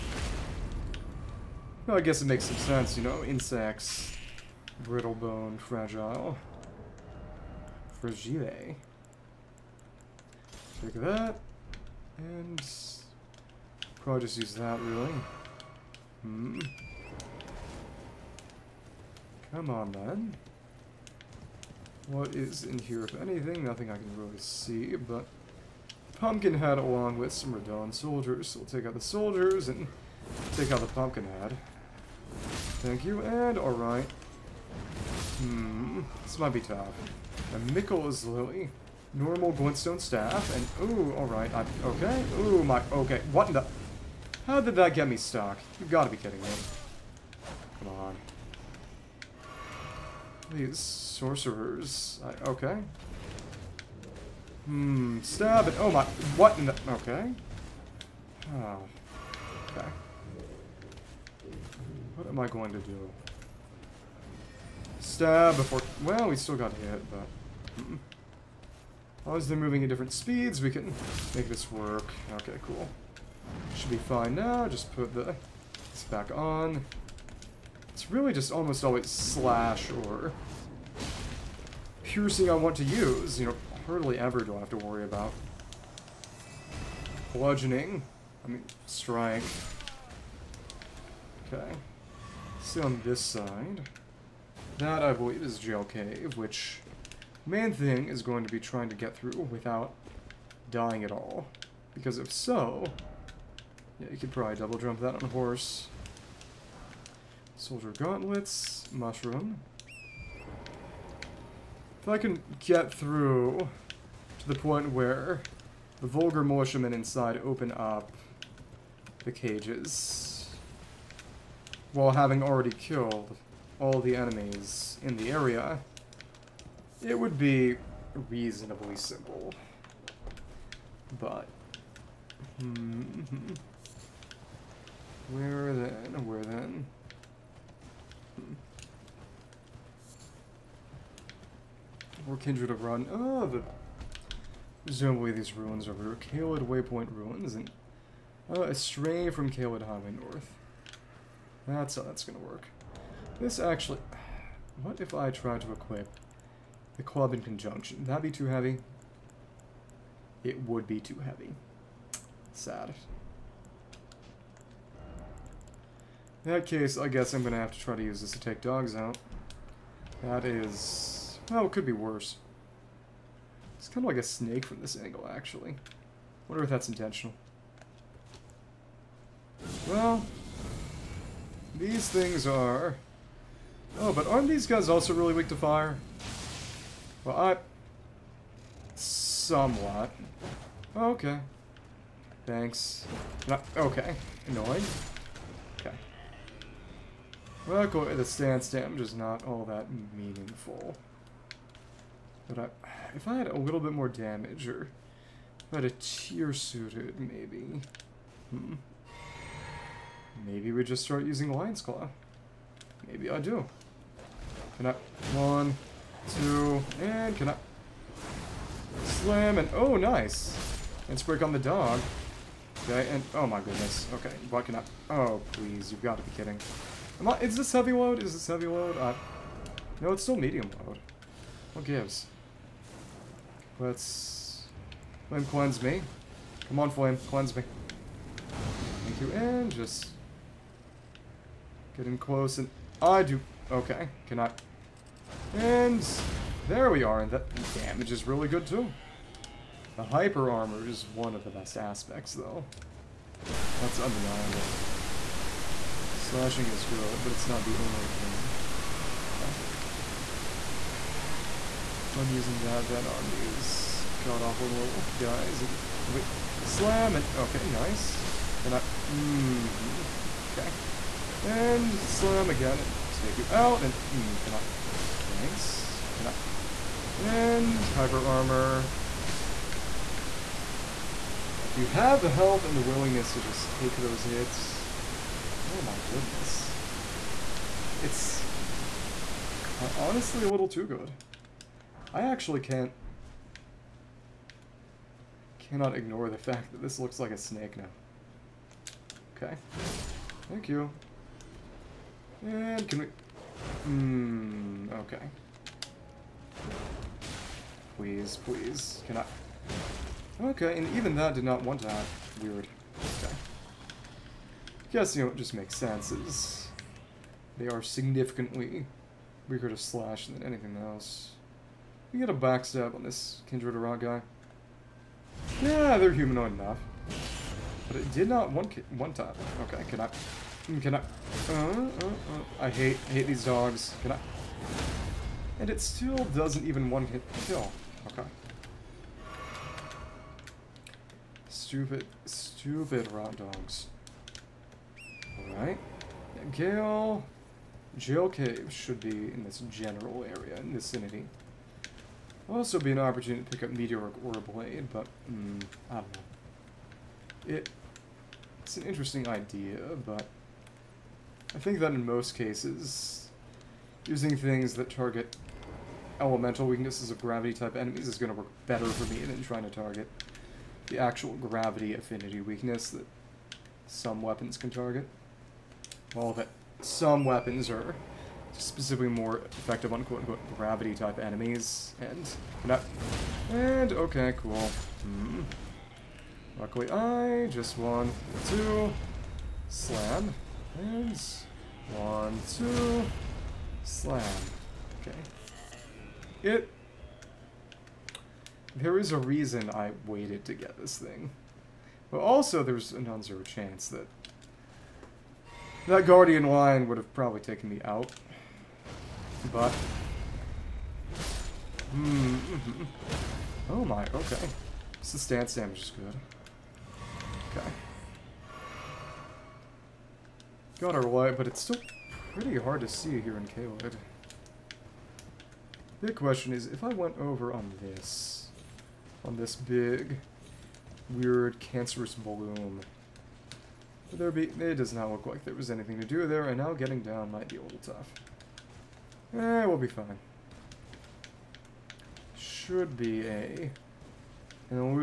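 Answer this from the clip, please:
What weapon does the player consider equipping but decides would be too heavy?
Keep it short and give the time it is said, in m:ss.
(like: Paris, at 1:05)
the club, at 2:36.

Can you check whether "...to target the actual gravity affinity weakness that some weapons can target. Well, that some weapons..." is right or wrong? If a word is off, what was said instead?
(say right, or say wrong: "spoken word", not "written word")
right.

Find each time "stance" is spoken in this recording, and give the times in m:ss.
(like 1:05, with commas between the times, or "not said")
3:18, 6:55.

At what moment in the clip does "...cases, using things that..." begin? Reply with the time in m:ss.
6:02.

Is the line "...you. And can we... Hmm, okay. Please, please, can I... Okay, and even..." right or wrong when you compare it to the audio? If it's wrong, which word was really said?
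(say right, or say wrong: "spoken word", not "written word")
right.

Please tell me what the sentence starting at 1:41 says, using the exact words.
Because if so, yeah, you could probably double jump that on a horse.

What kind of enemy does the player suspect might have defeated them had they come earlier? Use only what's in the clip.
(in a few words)
Guardian lion.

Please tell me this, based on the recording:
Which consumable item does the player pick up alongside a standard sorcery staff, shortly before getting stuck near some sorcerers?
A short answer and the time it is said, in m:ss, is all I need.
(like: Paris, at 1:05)
Miquella's Lily, at 0:37.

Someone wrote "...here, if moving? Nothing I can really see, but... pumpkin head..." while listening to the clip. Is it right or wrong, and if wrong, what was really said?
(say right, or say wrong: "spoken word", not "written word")
wrong: "anything", not "moving".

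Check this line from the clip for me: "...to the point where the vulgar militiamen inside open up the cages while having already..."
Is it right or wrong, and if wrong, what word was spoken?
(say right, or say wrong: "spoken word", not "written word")
right.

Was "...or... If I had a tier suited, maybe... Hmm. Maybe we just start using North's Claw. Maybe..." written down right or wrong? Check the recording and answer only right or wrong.
wrong.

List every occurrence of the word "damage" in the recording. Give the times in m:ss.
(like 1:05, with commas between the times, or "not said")
3:18, 3:24, 4:07, 6:55.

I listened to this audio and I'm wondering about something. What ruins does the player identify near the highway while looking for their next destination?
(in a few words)
Caelid Waypoint Ruins.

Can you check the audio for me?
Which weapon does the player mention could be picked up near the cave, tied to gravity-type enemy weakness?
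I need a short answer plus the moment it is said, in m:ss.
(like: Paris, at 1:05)
Meteoric Ore Blade, at 5:53.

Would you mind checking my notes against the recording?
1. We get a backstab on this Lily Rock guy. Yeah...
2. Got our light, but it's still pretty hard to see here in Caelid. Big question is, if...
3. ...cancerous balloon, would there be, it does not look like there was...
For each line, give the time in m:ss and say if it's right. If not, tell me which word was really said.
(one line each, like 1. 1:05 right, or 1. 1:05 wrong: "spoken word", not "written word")
1. 5:22 wrong: "Kindred", not "Lily"
2. 7:00 right
3. 7:11 right.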